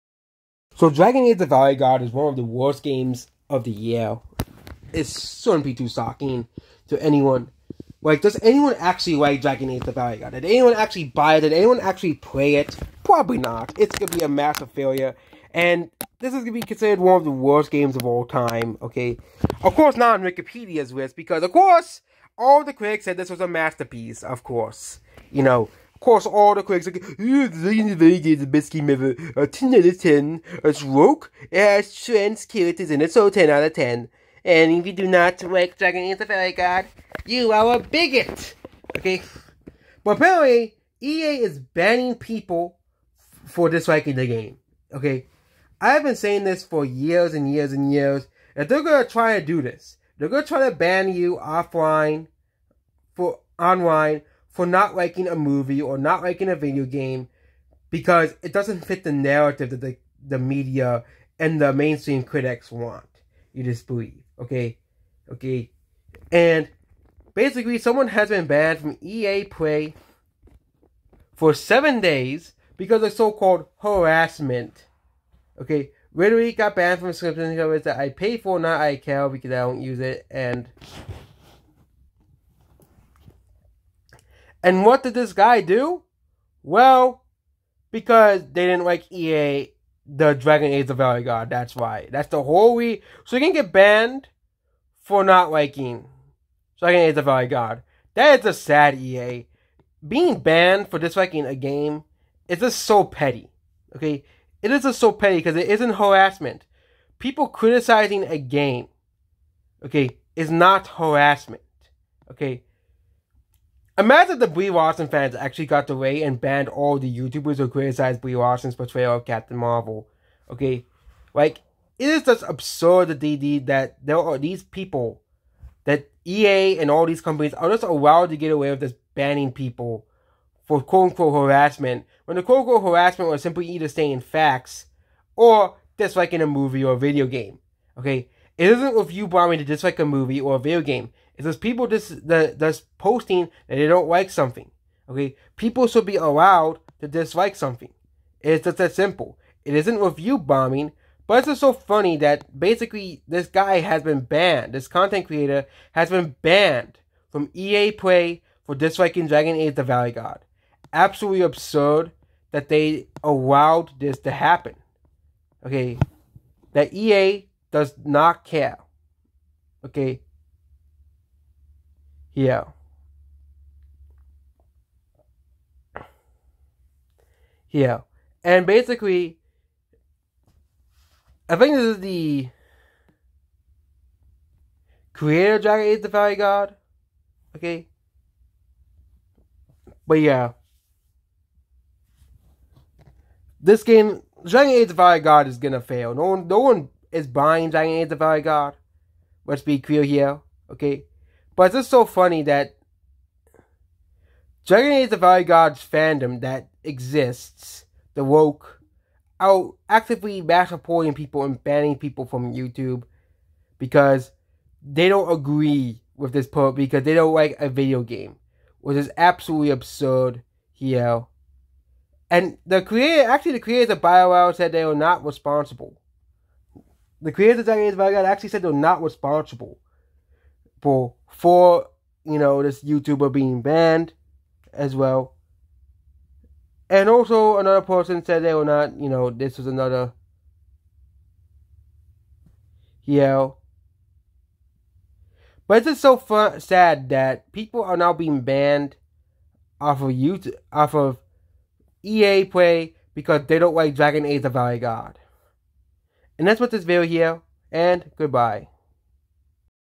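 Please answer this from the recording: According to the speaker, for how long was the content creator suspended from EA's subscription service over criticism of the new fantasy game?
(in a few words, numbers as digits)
7 days.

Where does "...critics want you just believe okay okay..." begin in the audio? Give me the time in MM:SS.
01:02.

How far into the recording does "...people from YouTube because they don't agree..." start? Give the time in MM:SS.
03:31.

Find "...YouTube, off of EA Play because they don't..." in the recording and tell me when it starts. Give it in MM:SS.
04:10.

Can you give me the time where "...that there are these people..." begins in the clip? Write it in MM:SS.
02:03.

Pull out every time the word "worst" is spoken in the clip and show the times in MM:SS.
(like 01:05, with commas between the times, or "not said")
00:02, 00:17.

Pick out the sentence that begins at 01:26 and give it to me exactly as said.
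Well, because they didn't like EA, the Dragon Age of Veilguard.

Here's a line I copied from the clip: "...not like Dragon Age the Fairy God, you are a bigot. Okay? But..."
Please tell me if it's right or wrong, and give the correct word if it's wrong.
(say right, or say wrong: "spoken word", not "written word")
right.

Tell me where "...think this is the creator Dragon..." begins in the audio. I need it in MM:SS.
03:01.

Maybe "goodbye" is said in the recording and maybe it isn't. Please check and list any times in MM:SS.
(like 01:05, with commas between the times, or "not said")
04:18.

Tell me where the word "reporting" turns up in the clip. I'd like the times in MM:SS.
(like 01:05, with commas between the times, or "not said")
03:30.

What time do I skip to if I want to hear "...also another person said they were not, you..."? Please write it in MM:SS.
03:57.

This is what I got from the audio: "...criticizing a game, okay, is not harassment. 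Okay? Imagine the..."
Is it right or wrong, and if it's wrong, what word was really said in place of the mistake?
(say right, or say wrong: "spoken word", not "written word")
right.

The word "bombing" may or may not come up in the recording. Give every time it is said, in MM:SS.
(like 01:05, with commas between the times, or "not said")
02:19, 02:30.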